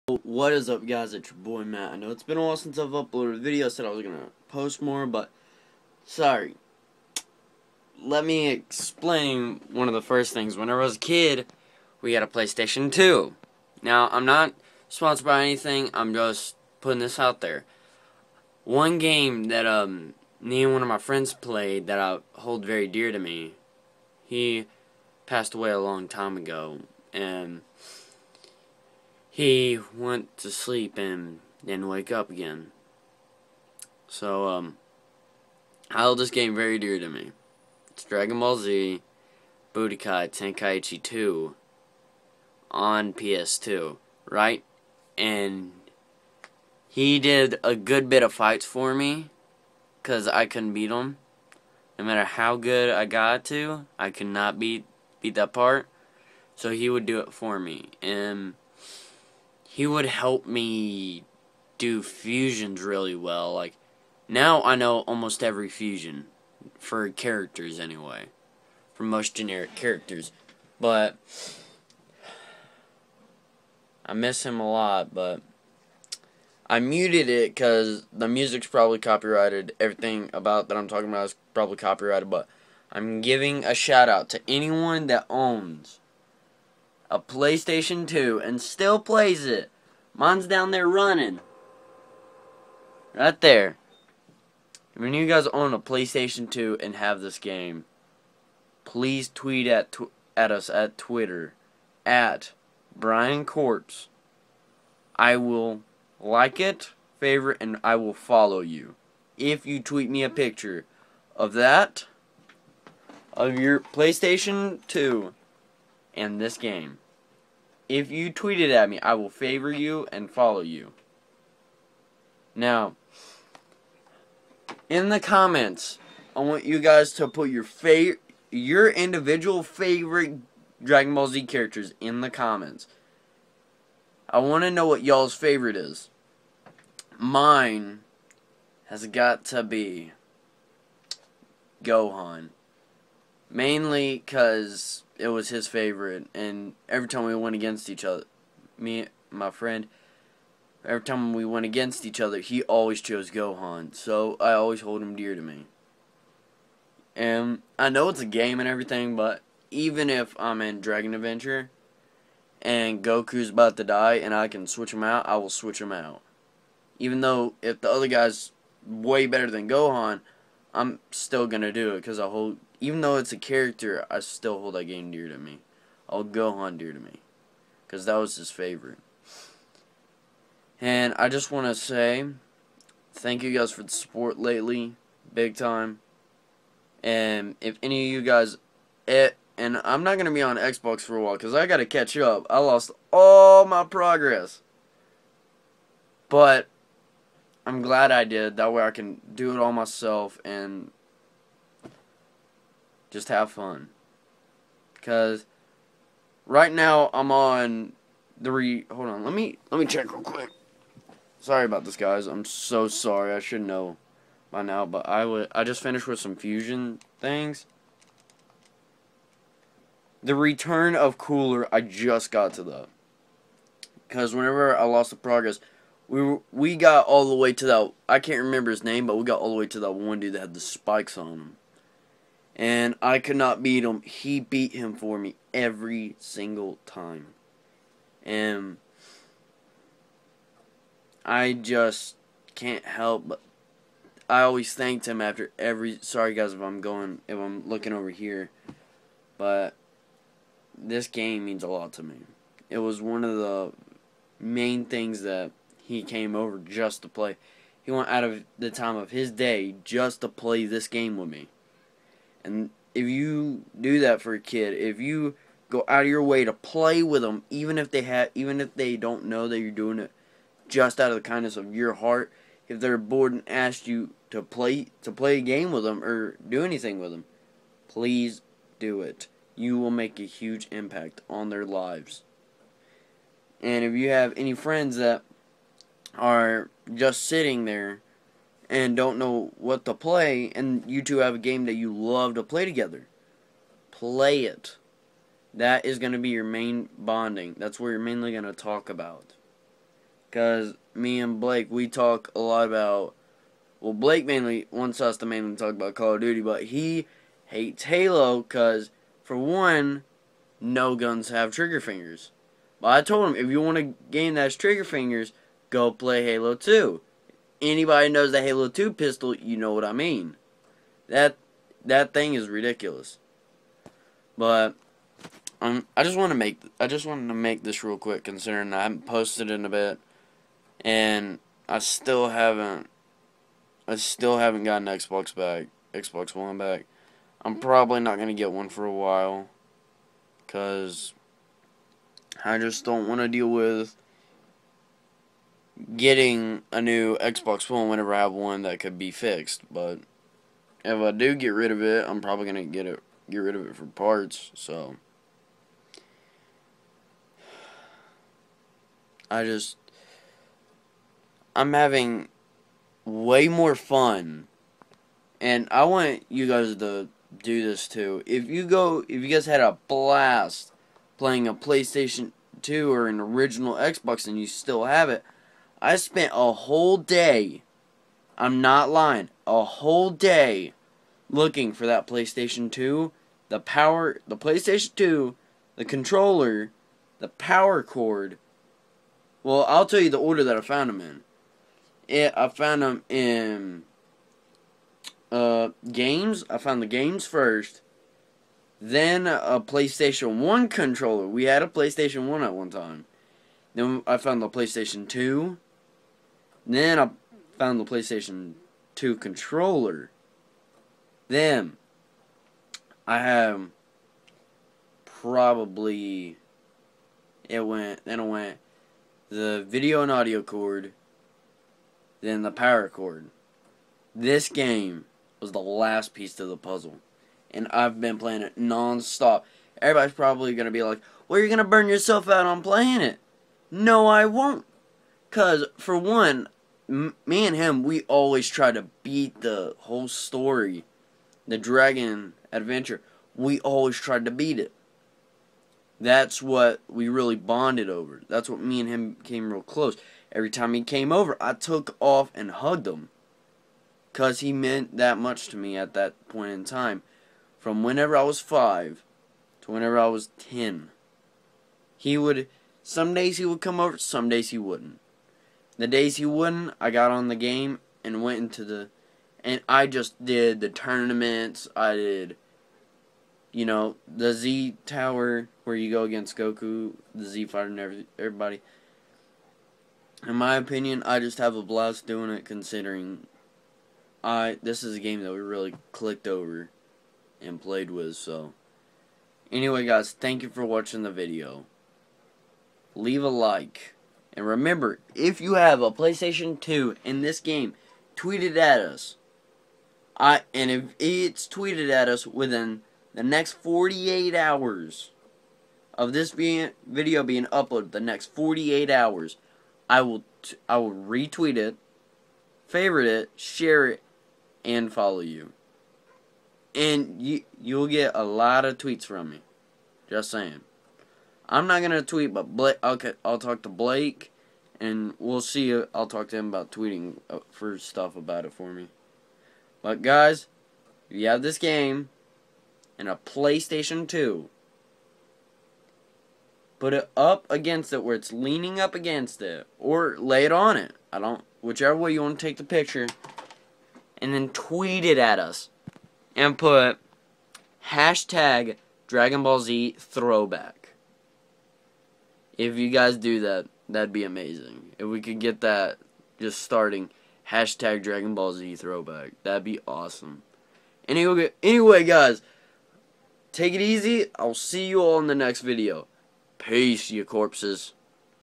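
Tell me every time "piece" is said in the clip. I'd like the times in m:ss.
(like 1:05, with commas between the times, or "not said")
7:06.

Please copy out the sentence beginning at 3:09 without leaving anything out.
It, eh, and I'm not going to be on Xbox for a while because I got to catch up.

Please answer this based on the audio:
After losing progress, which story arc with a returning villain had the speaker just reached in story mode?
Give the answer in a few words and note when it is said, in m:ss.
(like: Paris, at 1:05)
The Return of Cooler, at 3:40.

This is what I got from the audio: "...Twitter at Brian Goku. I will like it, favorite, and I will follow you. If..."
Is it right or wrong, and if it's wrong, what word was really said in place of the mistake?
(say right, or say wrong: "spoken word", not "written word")
wrong: "Corps", not "Goku".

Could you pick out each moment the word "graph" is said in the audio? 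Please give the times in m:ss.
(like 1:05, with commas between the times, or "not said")
not said.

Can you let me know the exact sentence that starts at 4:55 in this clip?
That is going to be your main bonding.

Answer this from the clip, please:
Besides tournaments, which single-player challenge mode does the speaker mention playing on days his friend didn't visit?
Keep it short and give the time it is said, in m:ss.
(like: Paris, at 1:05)
Z Tower, at 7:54.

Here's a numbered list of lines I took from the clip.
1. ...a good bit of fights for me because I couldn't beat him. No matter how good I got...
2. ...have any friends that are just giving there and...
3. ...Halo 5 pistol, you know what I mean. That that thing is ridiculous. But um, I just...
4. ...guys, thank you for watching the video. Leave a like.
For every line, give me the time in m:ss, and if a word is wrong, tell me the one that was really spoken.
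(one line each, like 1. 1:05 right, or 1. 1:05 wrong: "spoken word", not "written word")
1. 0:47 right
2. 4:44 wrong: "sitting", not "giving"
3. 5:18 wrong: "2", not "5"
4. 8:09 right.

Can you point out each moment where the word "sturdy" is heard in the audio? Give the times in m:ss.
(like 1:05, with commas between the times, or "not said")
not said.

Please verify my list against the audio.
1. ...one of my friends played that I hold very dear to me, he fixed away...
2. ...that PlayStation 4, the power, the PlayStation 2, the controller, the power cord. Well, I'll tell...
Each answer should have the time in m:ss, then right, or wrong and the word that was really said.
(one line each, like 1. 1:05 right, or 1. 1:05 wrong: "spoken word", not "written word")
1. 0:20 wrong: "passed", not "fixed"
2. 6:21 wrong: "2", not "4".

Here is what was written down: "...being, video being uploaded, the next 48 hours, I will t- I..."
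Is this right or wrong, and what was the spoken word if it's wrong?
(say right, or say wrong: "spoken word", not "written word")
right.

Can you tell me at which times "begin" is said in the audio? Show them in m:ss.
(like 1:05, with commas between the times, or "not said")
not said.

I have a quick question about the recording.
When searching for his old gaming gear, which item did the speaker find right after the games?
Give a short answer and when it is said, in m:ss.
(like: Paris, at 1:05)
PlayStation 1 controller, at 6:39.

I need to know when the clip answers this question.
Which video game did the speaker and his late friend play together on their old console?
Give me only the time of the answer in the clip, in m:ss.
0:38.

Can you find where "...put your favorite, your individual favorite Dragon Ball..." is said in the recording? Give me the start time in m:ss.
2:07.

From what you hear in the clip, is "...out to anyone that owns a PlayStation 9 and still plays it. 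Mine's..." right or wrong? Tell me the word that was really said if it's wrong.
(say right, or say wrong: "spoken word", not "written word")
wrong: "2", not "9".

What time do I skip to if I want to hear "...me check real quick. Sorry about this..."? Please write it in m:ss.
3:29.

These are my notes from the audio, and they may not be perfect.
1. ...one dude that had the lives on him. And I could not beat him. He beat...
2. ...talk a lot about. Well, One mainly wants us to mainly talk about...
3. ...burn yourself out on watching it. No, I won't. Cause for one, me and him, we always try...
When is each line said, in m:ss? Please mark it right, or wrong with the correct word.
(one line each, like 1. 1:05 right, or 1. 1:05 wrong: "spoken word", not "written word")
1. 3:49 wrong: "spikes", not "lives"
2. 5:01 wrong: "Blake", not "One"
3. 7:11 wrong: "playing", not "watching".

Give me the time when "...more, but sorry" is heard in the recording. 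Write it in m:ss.
0:04.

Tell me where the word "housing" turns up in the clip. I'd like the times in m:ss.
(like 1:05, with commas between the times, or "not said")
not said.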